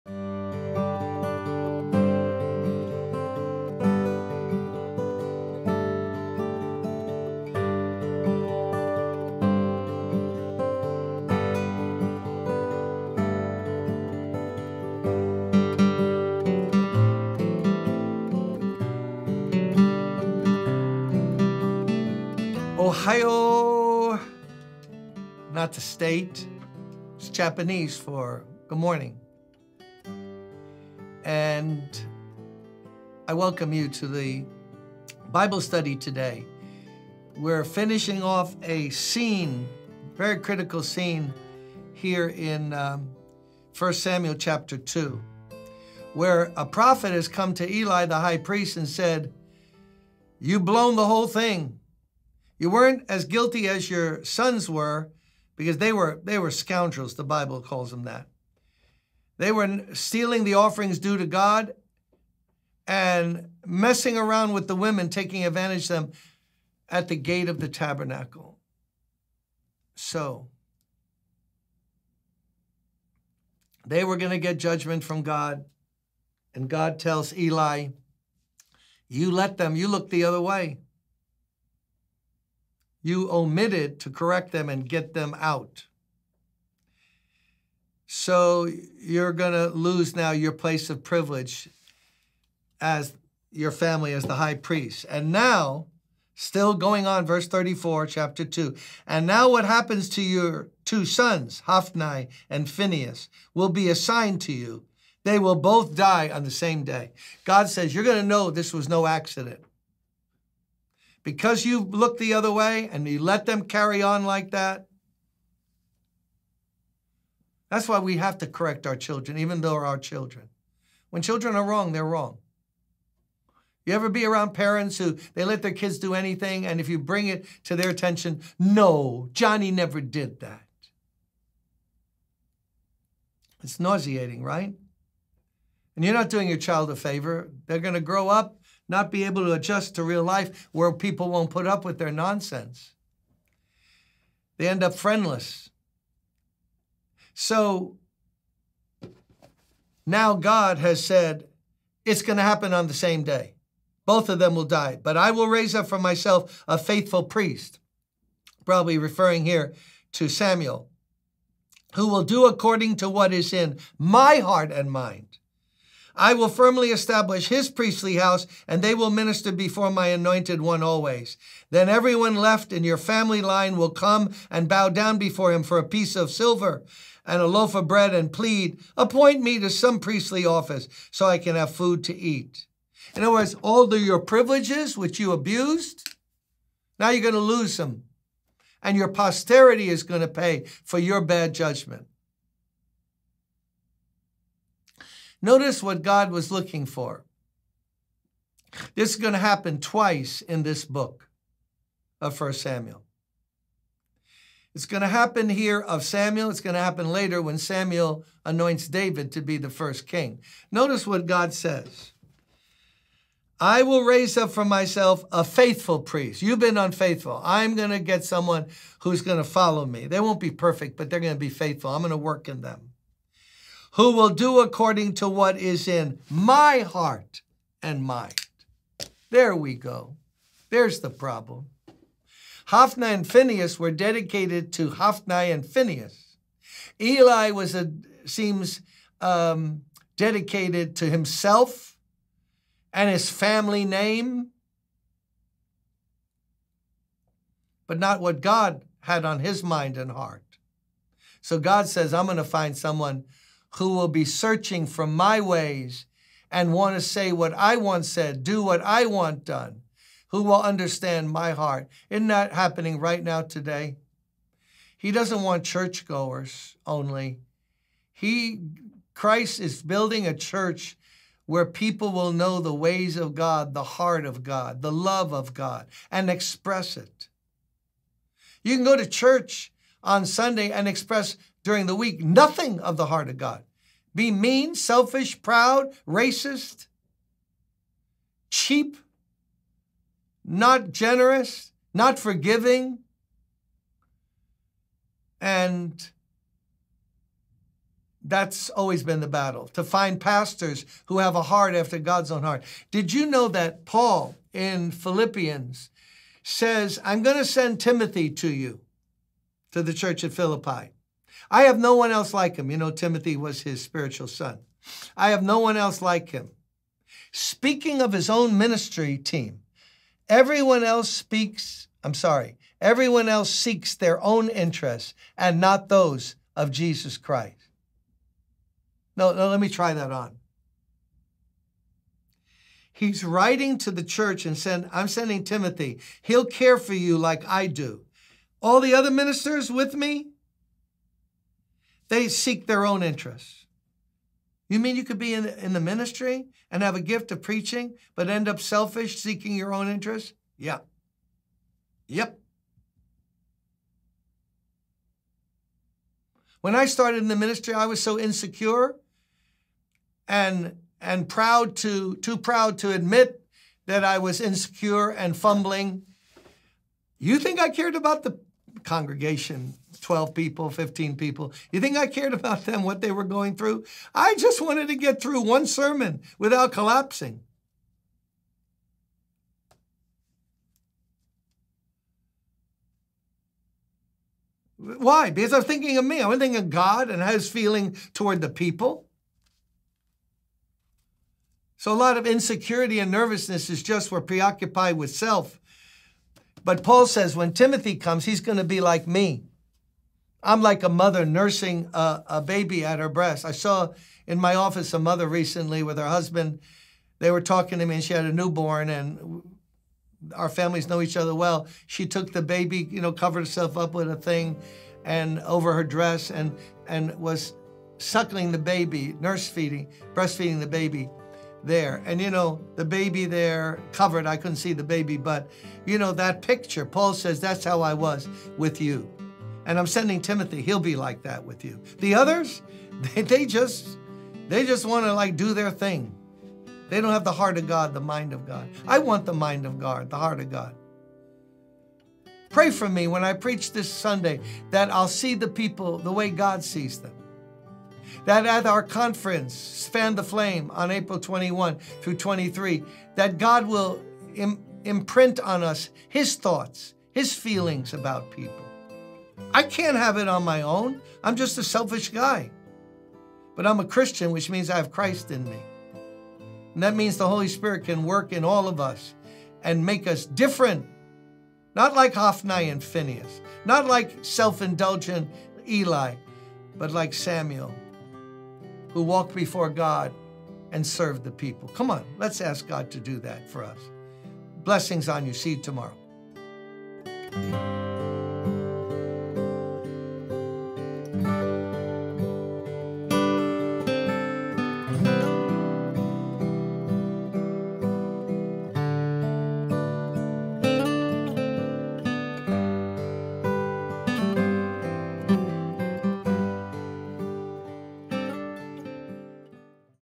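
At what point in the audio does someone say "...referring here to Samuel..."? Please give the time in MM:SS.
02:38.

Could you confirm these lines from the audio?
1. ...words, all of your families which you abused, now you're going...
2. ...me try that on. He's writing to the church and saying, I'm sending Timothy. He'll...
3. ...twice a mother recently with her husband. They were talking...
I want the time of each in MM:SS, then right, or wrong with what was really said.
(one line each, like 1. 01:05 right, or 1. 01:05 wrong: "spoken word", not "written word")
1. 03:03 wrong: "privileges", not "families"
2. 05:29 right
3. 06:44 wrong: "office", not "twice".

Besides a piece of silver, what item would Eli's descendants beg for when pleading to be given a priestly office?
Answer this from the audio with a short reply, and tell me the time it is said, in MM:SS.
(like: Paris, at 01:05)
a loaf of bread, at 02:57.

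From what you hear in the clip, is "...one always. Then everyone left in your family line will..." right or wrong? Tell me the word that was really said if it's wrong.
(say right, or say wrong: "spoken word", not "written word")
right.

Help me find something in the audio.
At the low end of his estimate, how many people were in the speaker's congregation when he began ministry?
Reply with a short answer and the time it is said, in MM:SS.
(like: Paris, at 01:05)
12, at 06:10.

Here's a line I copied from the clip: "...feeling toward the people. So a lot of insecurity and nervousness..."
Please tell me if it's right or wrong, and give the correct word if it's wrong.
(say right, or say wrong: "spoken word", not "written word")
right.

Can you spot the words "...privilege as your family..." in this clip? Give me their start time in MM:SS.
01:31.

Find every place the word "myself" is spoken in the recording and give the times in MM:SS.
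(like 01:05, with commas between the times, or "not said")
02:35, 03:34.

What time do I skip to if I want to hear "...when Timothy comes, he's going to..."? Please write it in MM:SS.
06:37.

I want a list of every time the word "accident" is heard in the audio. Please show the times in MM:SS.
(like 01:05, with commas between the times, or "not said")
01:49.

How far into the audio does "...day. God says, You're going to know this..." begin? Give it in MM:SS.
01:46.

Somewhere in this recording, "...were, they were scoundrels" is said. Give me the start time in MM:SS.
00:55.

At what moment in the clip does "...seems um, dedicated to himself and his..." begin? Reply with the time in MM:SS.
03:58.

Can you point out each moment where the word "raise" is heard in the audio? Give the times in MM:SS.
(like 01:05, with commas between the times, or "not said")
02:35, 03:34.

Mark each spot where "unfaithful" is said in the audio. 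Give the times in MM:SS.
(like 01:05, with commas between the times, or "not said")
03:36.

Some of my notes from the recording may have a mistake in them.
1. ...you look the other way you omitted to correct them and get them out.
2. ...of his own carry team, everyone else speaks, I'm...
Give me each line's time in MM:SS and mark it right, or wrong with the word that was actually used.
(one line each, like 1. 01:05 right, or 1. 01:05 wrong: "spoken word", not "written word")
1. 01:19 right
2. 05:18 wrong: "ministry", not "carry".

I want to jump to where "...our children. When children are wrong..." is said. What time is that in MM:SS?
01:59.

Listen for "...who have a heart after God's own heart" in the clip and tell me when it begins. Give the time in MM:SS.
05:01.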